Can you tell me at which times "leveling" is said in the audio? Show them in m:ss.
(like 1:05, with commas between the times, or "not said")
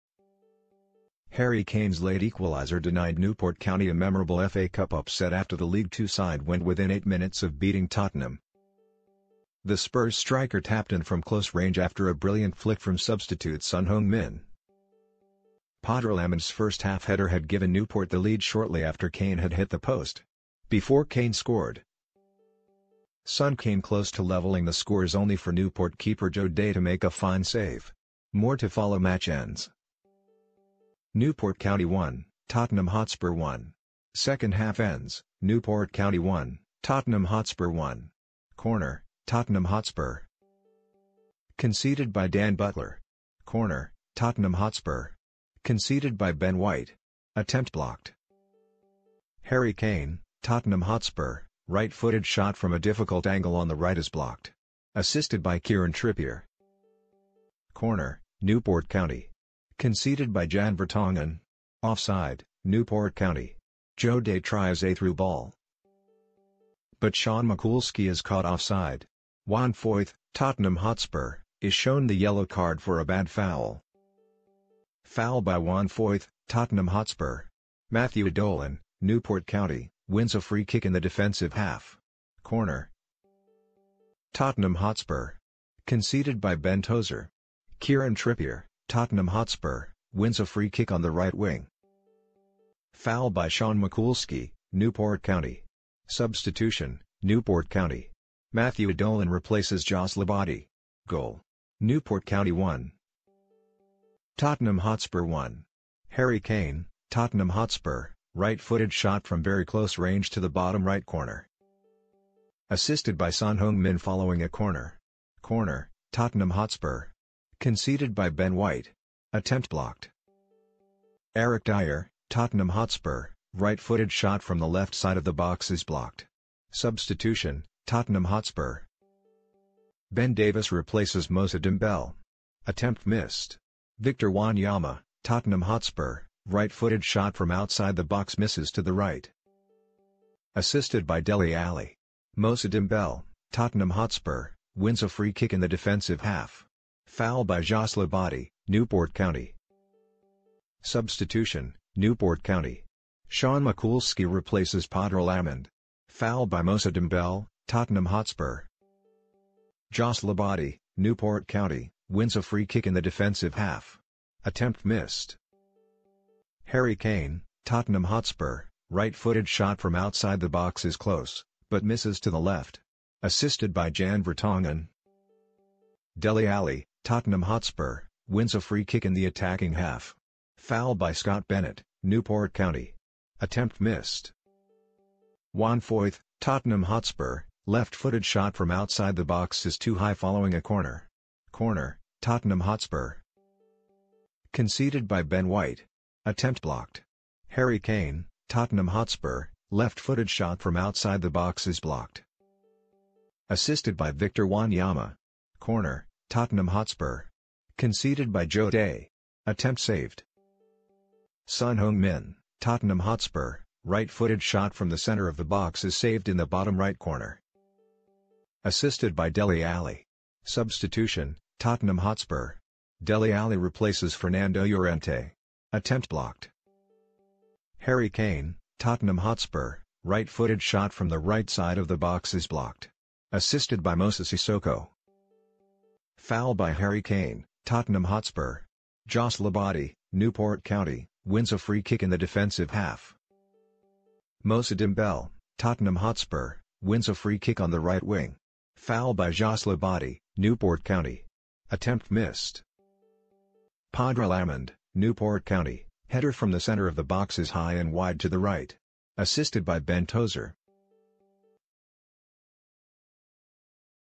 0:24.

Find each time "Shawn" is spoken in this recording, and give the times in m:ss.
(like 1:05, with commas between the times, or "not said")
1:07, 1:33, 2:33.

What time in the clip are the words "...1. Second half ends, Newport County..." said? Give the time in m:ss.
0:33.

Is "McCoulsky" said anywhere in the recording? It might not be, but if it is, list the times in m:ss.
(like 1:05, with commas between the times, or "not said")
1:07, 1:33, 2:33.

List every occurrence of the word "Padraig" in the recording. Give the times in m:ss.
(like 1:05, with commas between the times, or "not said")
2:34, 4:13.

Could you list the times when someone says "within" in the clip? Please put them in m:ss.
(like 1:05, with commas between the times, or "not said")
0:06.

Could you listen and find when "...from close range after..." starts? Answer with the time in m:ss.
0:11.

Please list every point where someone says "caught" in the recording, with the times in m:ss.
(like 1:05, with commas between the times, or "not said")
1:08.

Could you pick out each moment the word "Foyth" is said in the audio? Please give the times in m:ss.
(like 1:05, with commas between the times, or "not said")
1:09, 1:15, 3:05.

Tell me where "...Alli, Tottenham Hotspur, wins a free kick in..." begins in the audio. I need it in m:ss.
2:56.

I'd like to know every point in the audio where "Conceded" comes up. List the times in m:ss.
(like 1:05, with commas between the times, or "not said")
0:41, 0:45, 0:59, 1:25, 1:57, 3:14, 3:27.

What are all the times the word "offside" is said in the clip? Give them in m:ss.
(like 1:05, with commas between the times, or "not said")
1:01, 1:08.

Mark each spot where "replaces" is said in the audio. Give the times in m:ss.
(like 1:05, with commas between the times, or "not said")
1:39, 2:10, 2:34, 3:43.